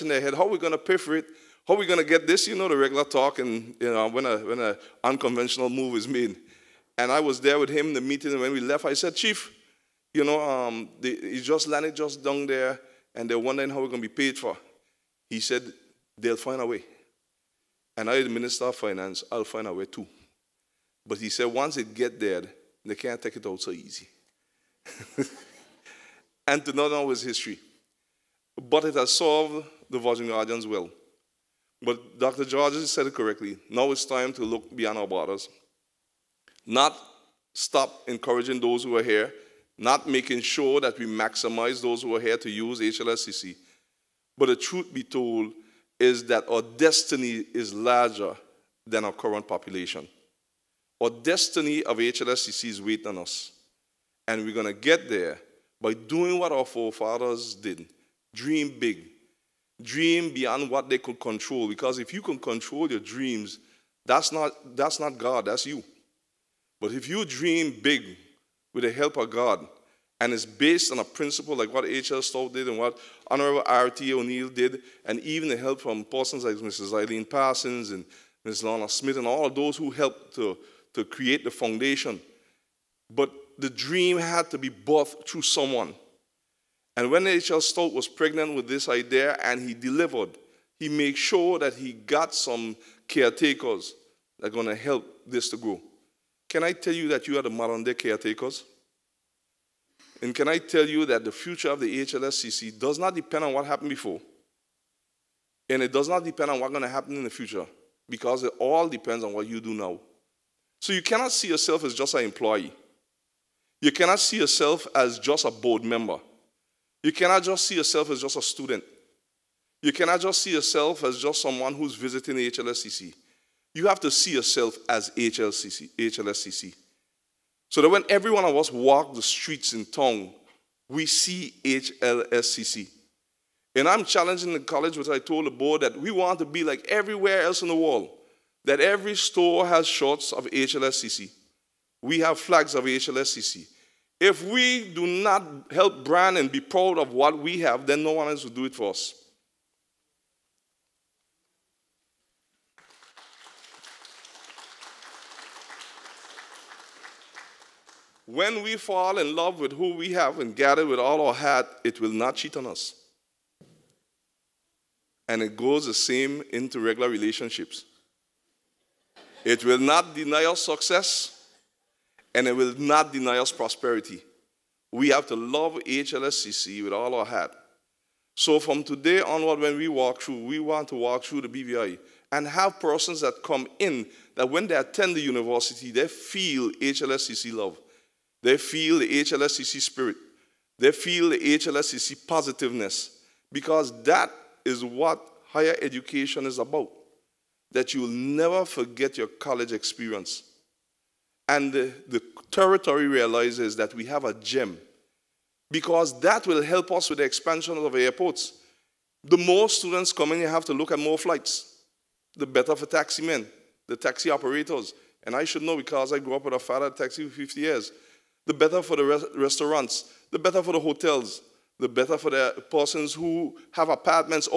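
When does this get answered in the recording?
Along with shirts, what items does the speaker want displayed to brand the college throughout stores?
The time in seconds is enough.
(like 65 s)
142 s.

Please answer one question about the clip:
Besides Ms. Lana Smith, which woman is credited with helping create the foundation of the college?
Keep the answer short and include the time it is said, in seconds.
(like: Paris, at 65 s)
Mrs. Eileen Parsons, at 76 s.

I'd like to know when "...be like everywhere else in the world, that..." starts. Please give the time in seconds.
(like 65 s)
136 s.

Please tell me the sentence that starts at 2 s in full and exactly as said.
You know, the regular talk and, you know, when an when a unconventional move is made.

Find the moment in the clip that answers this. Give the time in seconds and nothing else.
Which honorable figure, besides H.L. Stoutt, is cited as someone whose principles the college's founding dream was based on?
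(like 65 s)
73 s.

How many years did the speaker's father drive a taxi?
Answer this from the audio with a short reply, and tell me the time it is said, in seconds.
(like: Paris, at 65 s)
50 years, at 217 s.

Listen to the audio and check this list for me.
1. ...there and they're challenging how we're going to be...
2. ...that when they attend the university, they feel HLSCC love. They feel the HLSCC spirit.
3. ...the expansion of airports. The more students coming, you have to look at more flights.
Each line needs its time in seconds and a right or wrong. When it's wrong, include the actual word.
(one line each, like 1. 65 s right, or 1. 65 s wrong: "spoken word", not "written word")
1. 12 s wrong: "wondering", not "challenging"
2. 184 s right
3. 207 s right.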